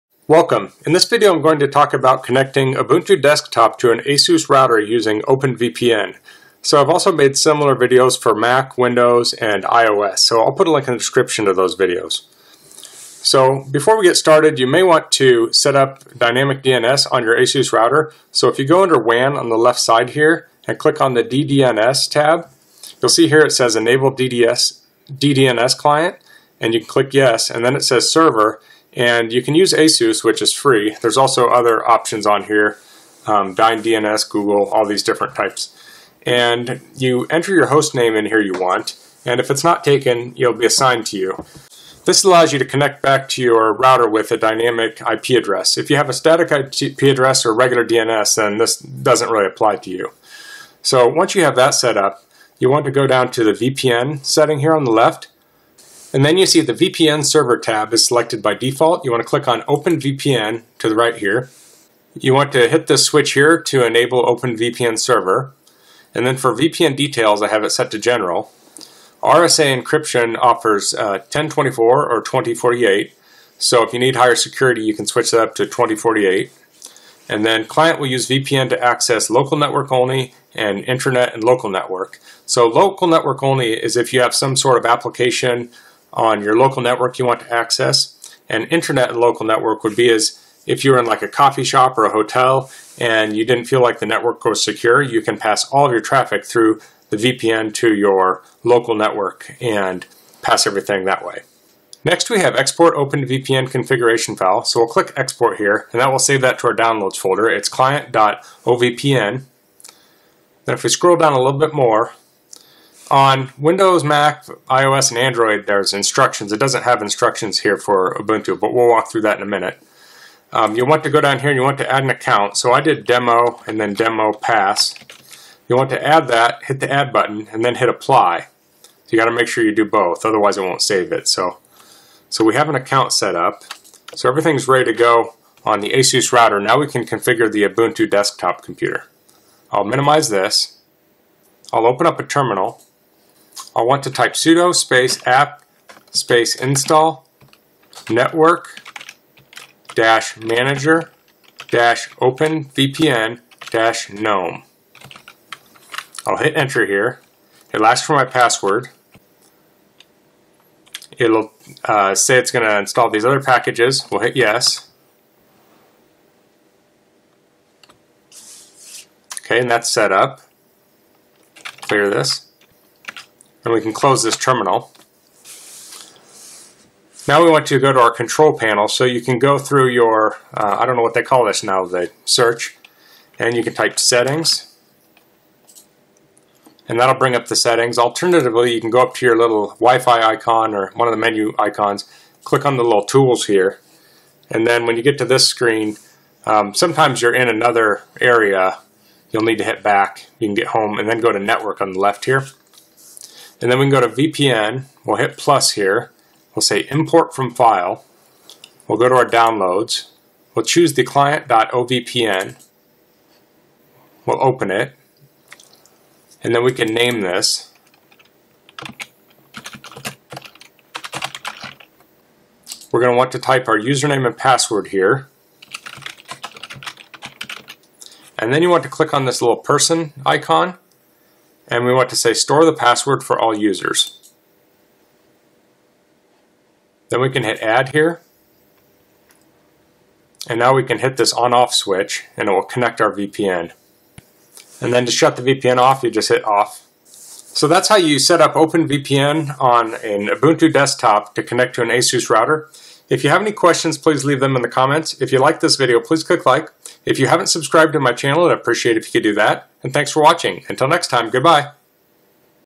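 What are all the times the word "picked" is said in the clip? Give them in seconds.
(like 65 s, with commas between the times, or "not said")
not said.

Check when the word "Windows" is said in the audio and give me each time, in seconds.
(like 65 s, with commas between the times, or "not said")
8 s, 113 s.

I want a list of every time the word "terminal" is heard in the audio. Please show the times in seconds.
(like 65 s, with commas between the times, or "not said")
142 s, 174 s.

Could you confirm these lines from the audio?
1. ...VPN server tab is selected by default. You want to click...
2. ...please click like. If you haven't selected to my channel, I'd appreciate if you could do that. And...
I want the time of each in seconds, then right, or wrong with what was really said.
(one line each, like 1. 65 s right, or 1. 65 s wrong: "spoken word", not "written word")
1. 56 s right
2. 255 s wrong: "subscribed", not "selected".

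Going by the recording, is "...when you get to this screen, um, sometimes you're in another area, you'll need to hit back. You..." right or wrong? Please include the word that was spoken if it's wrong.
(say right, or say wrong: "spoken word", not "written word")
right.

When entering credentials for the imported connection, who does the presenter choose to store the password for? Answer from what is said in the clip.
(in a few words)
all users.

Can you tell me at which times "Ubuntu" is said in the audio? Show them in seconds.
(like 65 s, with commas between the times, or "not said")
2 s, 118 s, 137 s, 250 s.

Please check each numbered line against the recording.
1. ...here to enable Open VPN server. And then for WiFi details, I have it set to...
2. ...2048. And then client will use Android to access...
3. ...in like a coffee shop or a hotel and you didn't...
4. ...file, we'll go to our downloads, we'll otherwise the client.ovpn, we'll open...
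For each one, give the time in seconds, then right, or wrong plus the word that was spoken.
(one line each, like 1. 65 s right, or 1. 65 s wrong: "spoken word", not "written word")
1. 63 s wrong: "VPN", not "WiFi"
2. 75 s wrong: "VPN", not "Android"
3. 90 s right
4. 207 s wrong: "choose", not "otherwise".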